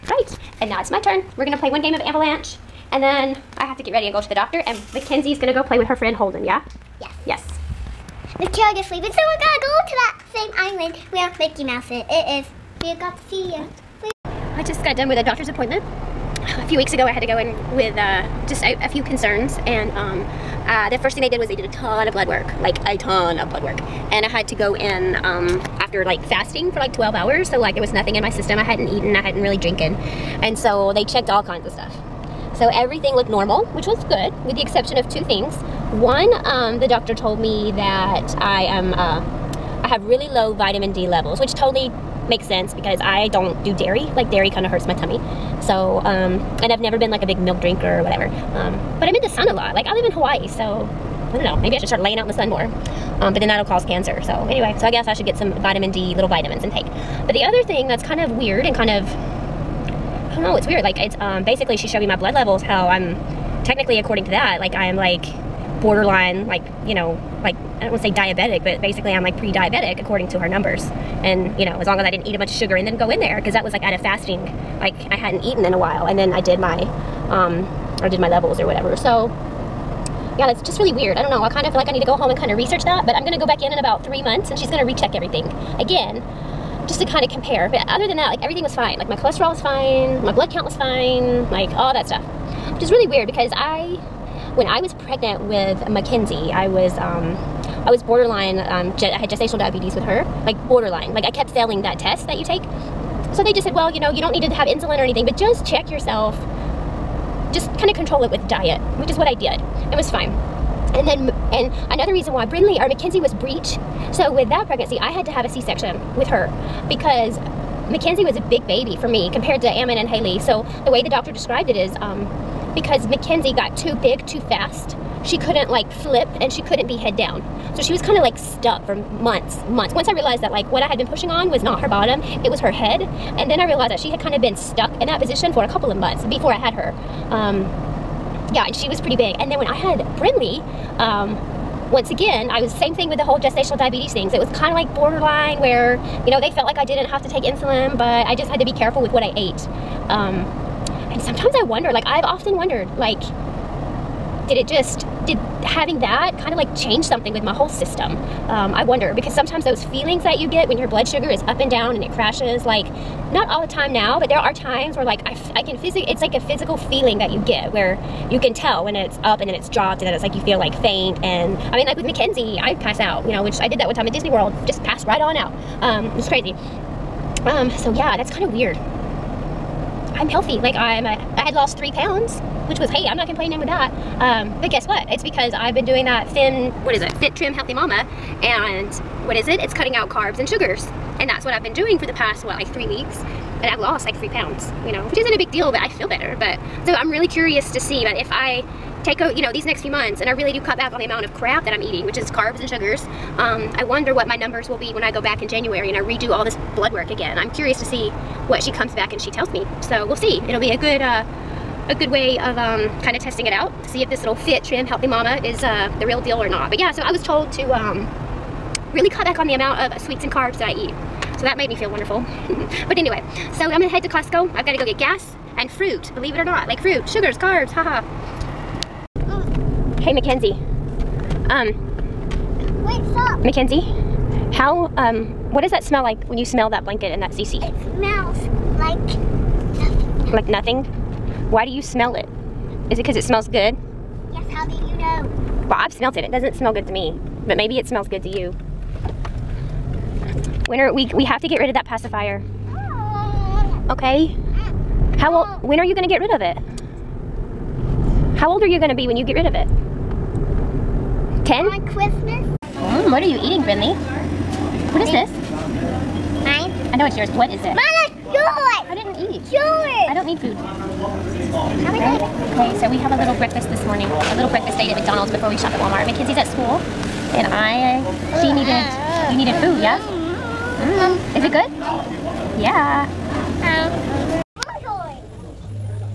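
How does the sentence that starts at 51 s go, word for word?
Maybe I should start laying out in the sun more.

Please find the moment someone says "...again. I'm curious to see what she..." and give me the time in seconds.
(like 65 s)
207 s.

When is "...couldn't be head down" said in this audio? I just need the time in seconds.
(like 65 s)
126 s.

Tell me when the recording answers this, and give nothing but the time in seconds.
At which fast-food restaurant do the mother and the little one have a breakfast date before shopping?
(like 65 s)
274 s.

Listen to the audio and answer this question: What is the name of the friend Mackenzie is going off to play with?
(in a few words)
Holden.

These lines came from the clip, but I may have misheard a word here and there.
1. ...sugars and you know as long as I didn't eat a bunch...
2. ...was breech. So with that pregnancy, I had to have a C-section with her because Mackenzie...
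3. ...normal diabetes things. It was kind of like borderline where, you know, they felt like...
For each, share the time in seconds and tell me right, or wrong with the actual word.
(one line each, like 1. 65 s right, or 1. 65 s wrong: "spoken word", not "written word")
1. 70 s wrong: "numbers", not "sugars"
2. 113 s right
3. 143 s wrong: "gestational", not "normal".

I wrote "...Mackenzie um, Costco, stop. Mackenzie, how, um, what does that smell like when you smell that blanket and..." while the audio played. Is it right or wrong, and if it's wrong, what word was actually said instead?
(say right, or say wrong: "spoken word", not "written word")
wrong: "Wait", not "Costco".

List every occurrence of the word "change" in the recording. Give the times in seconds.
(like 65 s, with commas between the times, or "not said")
156 s.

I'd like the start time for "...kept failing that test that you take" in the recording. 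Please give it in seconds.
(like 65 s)
101 s.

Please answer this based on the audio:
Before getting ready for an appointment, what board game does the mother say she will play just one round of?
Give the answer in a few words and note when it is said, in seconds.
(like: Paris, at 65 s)
Avalanche, at 1 s.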